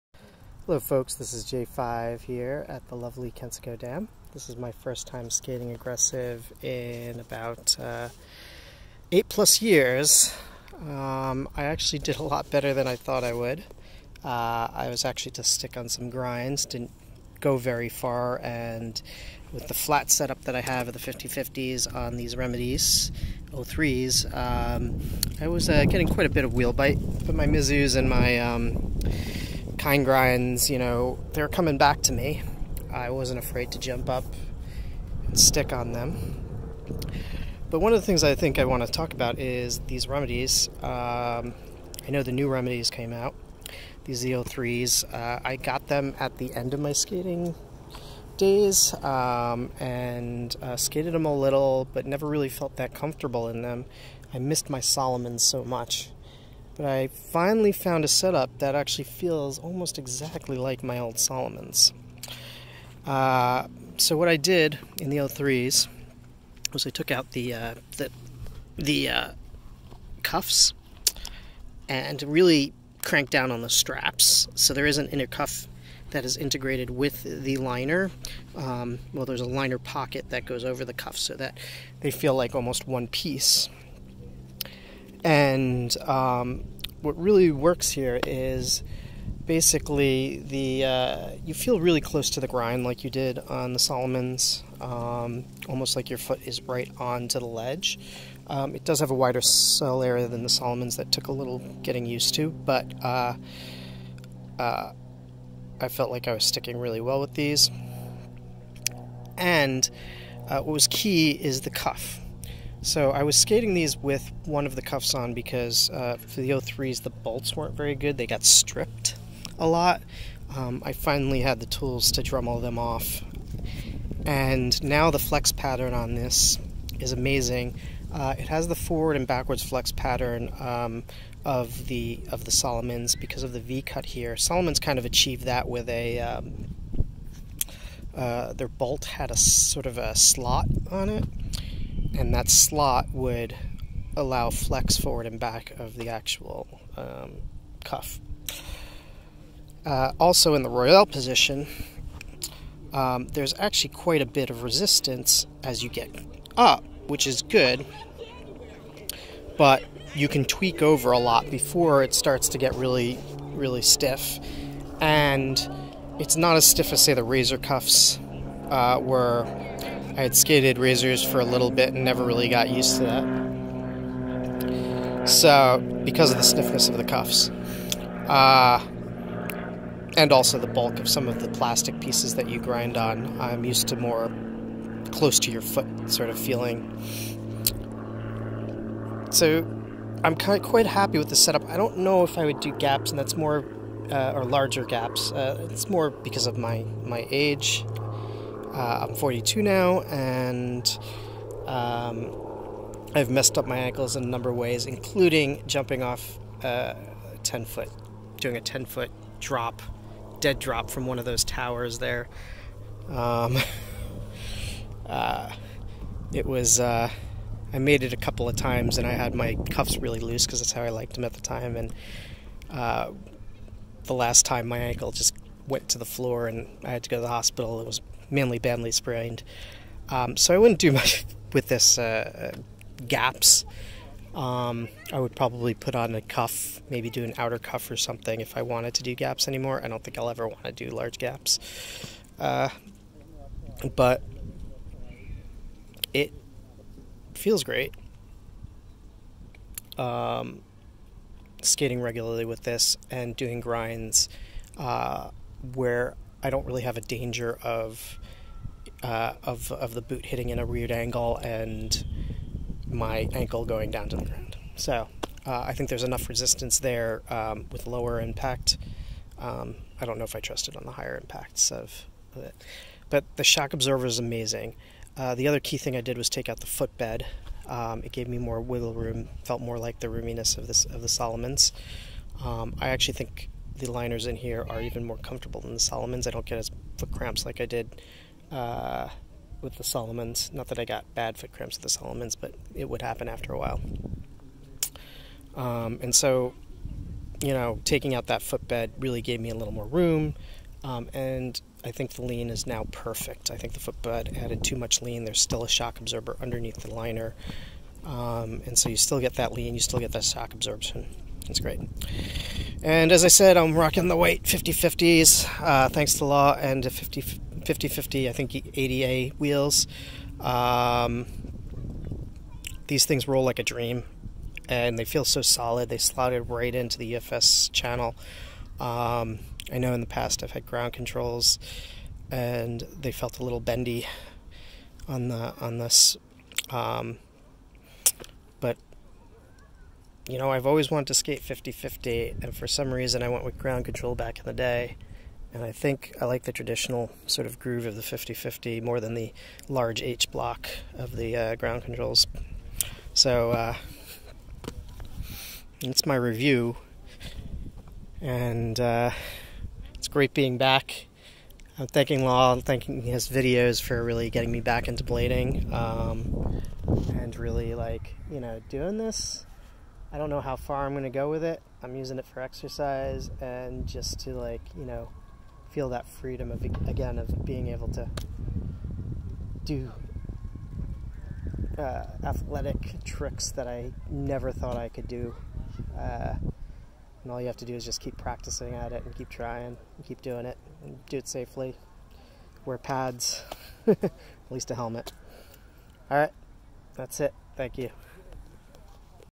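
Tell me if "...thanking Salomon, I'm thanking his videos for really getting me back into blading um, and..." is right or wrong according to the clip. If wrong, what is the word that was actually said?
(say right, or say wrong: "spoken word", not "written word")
wrong: "Law", not "Salomon".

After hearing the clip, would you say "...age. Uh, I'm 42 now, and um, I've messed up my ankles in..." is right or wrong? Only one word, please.
right.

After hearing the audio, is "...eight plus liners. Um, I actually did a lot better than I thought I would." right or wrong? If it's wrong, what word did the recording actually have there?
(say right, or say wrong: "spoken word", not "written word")
wrong: "years", not "liners".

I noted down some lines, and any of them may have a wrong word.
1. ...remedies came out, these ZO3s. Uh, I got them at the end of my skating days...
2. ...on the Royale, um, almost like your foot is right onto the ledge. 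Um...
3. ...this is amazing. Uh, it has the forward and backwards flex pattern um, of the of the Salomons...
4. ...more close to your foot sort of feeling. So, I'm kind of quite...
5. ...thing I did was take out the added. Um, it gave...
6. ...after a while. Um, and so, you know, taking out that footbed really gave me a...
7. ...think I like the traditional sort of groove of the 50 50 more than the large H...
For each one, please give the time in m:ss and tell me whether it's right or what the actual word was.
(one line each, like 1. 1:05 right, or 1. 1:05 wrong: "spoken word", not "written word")
1. 0:42 right
2. 1:33 wrong: "Salomons", not "Royale"
3. 2:06 right
4. 3:03 right
5. 4:35 wrong: "footbed", not "added"
6. 4:53 right
7. 5:45 right.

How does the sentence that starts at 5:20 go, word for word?
Um, these things roll like a dream, and they feel so solid.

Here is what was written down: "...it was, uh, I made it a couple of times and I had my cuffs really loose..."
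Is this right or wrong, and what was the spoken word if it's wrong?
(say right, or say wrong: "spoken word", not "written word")
right.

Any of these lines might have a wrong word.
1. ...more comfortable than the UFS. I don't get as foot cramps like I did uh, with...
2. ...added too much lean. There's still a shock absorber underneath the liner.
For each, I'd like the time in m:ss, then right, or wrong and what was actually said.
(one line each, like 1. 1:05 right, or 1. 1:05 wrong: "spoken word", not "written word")
1. 4:45 wrong: "Salomons", not "UFS"
2. 5:04 right.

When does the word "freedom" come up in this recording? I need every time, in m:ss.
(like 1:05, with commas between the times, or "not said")
6:16.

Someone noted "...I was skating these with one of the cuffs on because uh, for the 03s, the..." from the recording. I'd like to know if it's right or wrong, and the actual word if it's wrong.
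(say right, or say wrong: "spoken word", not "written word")
right.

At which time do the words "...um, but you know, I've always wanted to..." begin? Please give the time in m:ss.
5:36.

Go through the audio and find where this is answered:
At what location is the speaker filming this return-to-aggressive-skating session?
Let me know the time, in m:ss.
0:03.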